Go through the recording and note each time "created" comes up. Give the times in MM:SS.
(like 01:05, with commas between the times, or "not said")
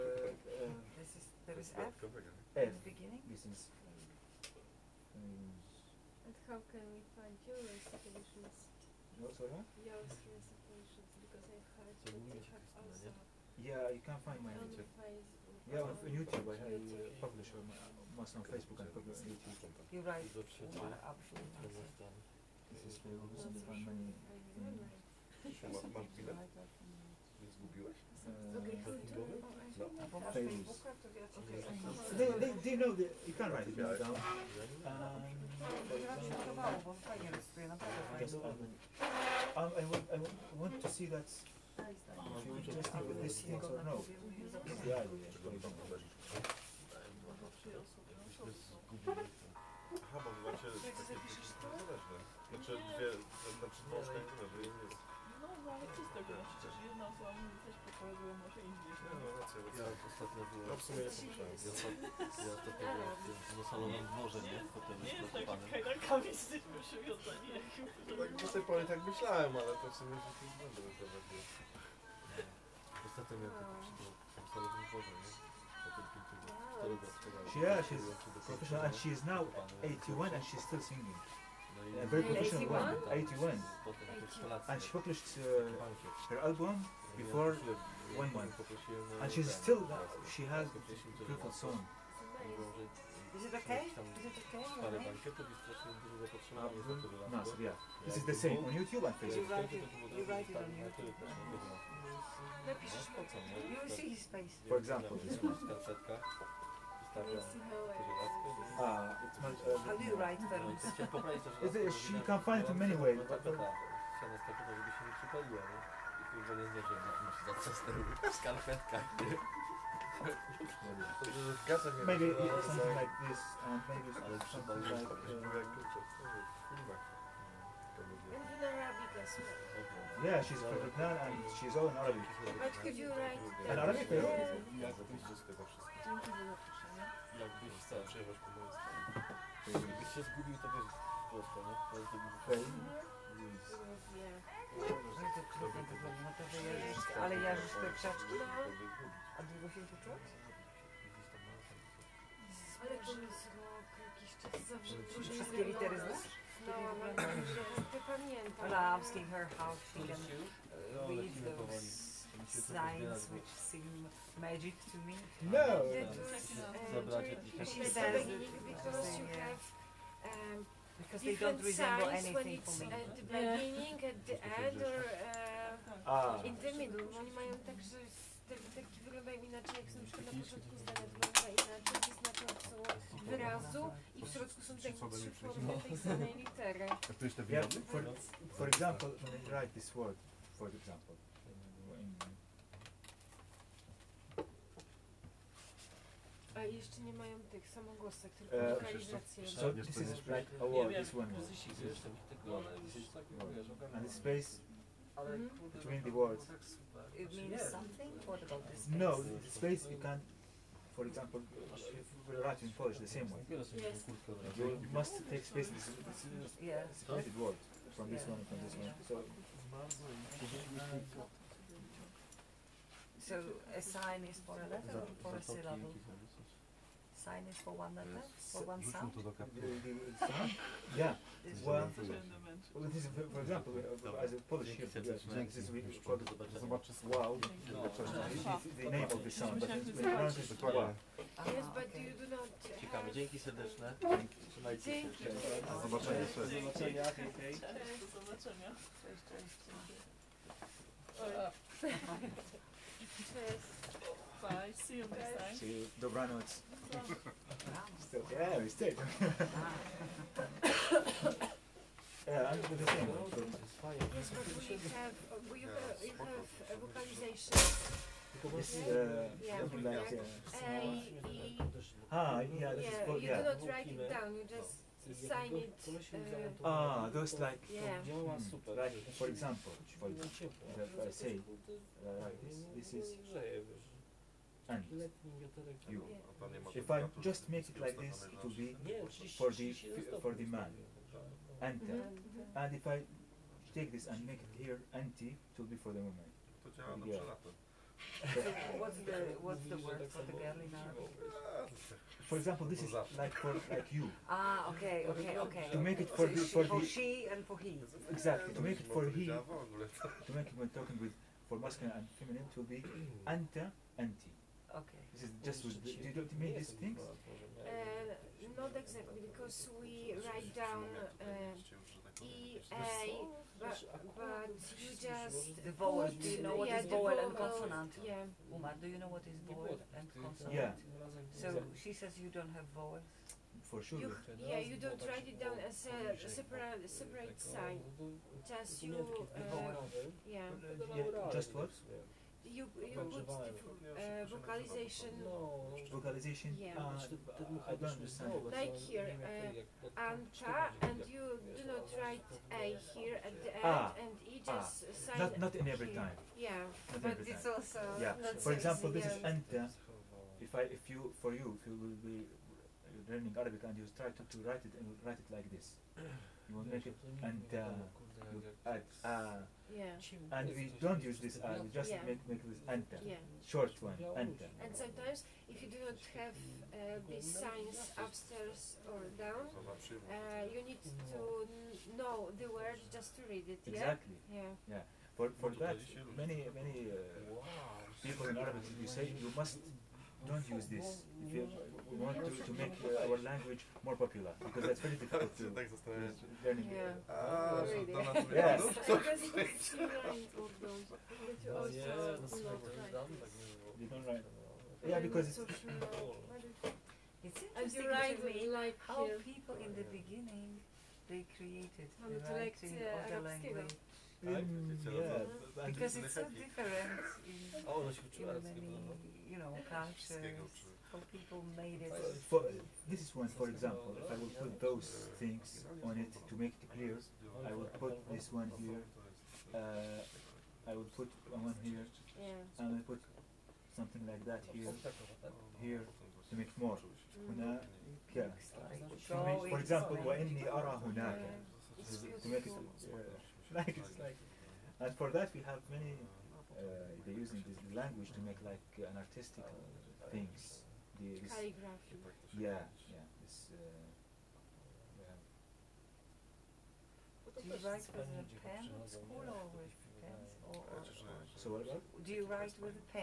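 06:51.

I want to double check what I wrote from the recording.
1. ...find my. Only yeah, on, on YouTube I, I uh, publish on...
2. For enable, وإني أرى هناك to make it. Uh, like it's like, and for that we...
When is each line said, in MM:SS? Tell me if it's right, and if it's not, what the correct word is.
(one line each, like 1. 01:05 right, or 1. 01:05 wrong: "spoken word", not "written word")
1. 00:14 right
2. 07:19 wrong: "example", not "enable".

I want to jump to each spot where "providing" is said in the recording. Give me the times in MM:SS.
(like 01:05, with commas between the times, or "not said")
not said.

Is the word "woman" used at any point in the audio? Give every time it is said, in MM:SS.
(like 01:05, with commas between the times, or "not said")
04:55.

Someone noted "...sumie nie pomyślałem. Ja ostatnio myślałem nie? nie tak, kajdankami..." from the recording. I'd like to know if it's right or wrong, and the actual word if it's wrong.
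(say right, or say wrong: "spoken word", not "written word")
wrong: "byłem", not "myślałem".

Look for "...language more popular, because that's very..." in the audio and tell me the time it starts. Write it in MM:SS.
06:33.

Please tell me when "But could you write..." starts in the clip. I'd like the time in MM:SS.
02:12.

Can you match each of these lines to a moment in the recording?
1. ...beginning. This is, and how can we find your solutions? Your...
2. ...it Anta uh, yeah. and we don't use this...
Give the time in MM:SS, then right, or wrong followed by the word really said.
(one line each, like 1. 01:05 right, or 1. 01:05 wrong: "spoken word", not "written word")
1. 00:02 right
2. 06:06 right.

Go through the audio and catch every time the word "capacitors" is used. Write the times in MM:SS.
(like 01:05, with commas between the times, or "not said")
not said.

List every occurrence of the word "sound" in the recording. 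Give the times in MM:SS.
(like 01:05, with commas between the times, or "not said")
03:48, 03:59.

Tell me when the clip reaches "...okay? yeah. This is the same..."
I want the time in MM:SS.
01:34.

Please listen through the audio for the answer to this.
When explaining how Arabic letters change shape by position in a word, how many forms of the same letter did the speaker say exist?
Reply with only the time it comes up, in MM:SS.
03:04.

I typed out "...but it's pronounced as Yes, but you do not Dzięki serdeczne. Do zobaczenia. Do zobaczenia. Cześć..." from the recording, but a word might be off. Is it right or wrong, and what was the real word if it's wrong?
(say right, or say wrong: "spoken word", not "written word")
right.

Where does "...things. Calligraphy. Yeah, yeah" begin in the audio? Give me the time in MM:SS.
07:30.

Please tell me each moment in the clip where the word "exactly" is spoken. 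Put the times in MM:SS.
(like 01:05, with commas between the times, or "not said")
05:08, 05:18, 06:23.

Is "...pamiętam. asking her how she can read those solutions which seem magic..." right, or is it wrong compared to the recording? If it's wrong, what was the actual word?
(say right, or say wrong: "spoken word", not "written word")
wrong: "signs", not "solutions".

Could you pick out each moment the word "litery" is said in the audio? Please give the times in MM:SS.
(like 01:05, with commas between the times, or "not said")
02:35, 03:06.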